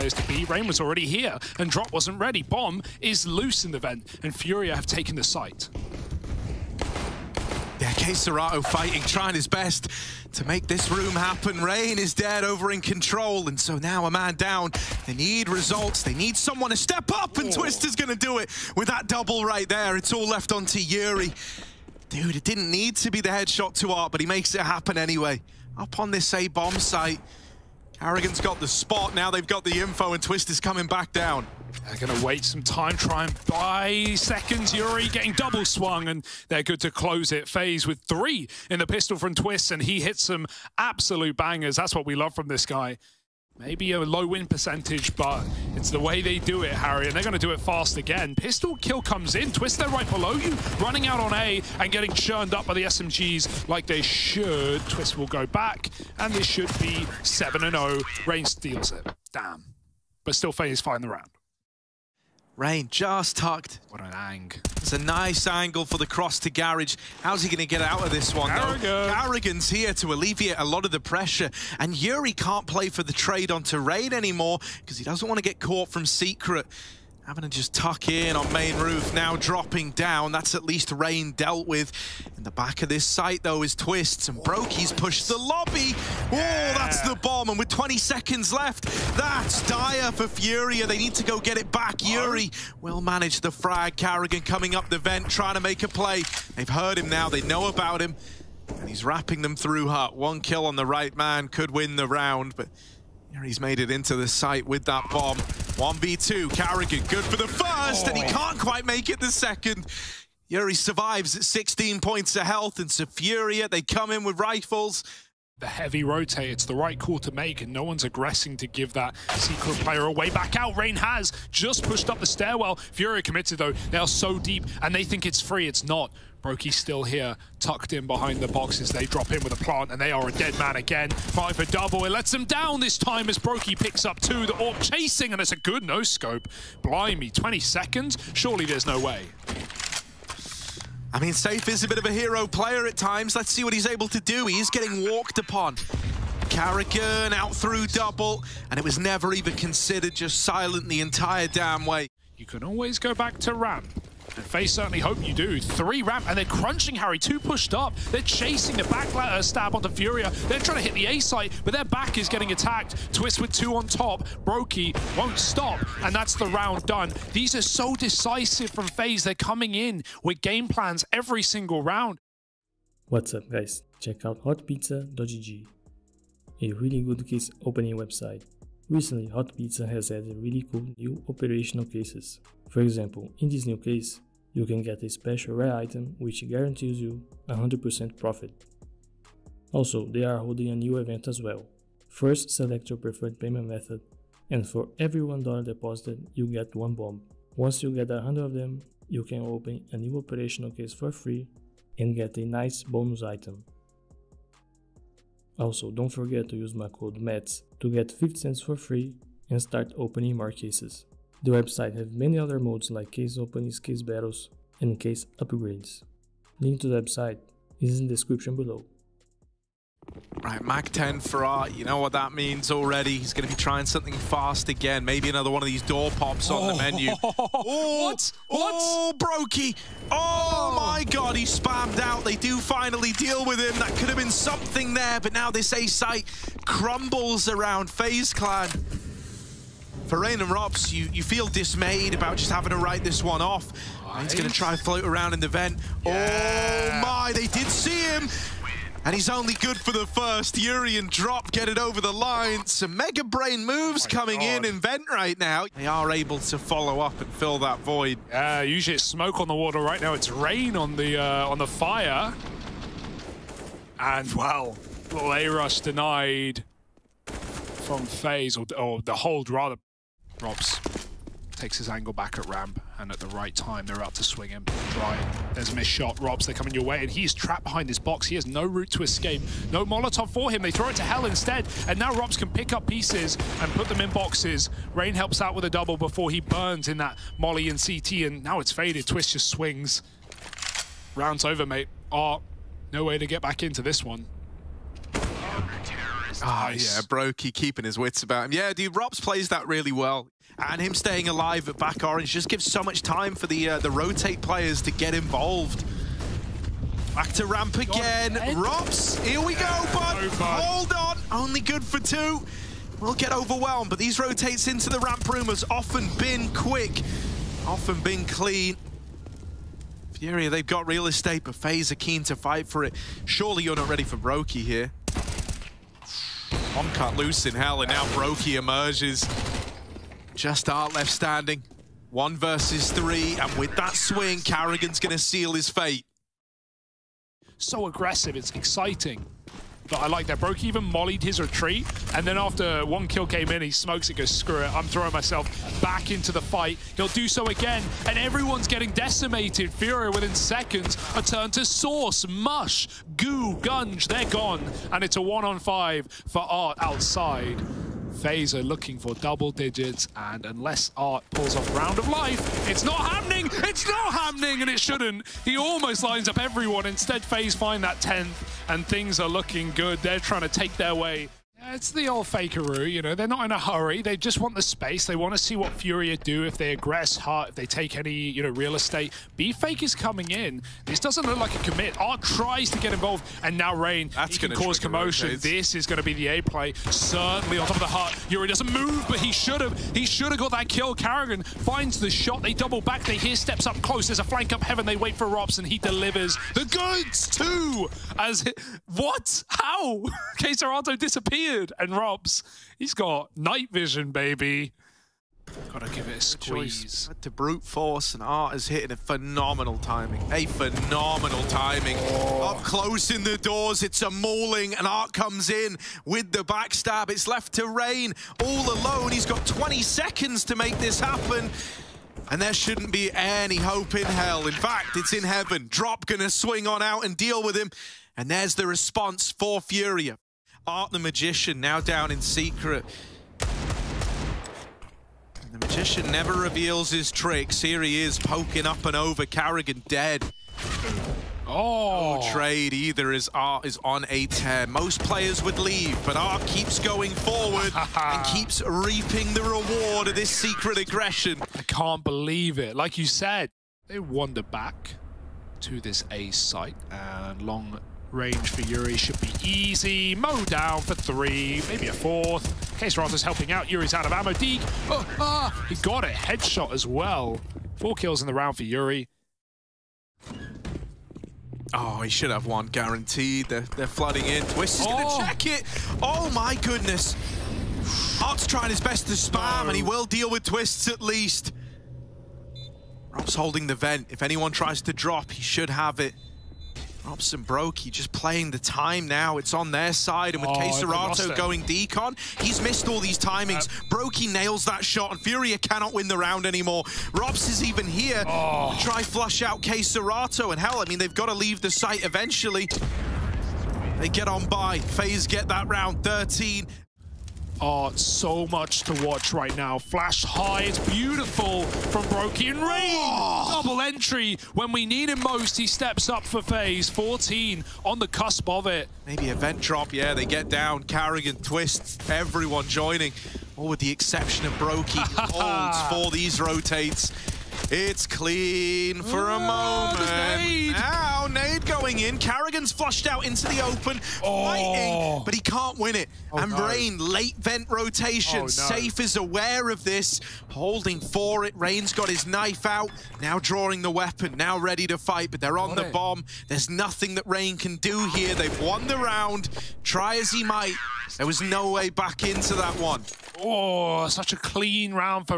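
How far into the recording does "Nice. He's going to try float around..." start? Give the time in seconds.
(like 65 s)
244 s.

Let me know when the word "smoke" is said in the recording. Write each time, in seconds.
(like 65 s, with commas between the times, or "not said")
259 s, 343 s.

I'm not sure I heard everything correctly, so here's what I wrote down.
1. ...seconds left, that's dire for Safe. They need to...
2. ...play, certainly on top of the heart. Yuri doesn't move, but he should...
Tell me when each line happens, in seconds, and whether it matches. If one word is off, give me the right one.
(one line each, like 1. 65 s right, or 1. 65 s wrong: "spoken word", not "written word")
1. 87 s wrong: "Furia", not "Safe"
2. 386 s right.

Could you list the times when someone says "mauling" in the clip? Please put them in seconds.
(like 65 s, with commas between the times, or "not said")
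414 s.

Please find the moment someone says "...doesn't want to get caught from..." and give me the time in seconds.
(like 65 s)
75 s.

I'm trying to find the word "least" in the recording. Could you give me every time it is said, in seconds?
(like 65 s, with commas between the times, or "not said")
80 s, 481 s.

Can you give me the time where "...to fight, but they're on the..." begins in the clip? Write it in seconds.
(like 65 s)
544 s.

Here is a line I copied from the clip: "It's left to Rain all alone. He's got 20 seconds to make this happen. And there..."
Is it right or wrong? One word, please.
right.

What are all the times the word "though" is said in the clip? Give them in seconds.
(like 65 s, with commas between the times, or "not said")
69 s, 83 s, 123 s.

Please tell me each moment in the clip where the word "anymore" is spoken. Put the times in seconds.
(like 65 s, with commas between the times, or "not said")
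74 s, 496 s.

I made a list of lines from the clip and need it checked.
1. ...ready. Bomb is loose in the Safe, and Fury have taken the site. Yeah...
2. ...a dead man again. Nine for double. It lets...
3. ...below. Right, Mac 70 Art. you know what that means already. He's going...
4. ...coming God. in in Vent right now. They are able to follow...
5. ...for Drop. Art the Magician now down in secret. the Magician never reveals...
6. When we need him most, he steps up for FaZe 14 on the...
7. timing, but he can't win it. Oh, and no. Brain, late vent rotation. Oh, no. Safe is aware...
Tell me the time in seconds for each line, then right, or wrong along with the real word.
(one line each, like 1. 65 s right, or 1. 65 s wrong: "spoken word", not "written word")
1. 2 s wrong: "Vent", not "Safe"
2. 130 s wrong: "Five", not "Nine"
3. 218 s wrong: "10", not "70"
4. 254 s right
5. 429 s wrong: "Furia", not "Drop"
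6. 514 s right
7. 534 s wrong: "fighting", not "timing".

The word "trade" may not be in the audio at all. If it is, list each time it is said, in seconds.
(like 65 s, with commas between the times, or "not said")
73 s, 442 s.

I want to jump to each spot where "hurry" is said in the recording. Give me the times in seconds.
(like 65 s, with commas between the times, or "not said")
373 s.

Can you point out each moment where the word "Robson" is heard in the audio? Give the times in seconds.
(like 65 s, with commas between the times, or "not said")
395 s, 487 s.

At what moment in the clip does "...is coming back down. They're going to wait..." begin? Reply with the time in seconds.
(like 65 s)
30 s.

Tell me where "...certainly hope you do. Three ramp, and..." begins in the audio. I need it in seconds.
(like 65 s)
154 s.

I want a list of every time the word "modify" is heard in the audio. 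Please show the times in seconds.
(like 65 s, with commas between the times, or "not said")
not said.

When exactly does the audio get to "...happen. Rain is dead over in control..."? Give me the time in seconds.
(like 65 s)
11 s.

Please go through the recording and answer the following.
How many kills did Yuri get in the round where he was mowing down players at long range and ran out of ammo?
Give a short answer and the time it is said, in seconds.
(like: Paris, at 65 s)
4, at 467 s.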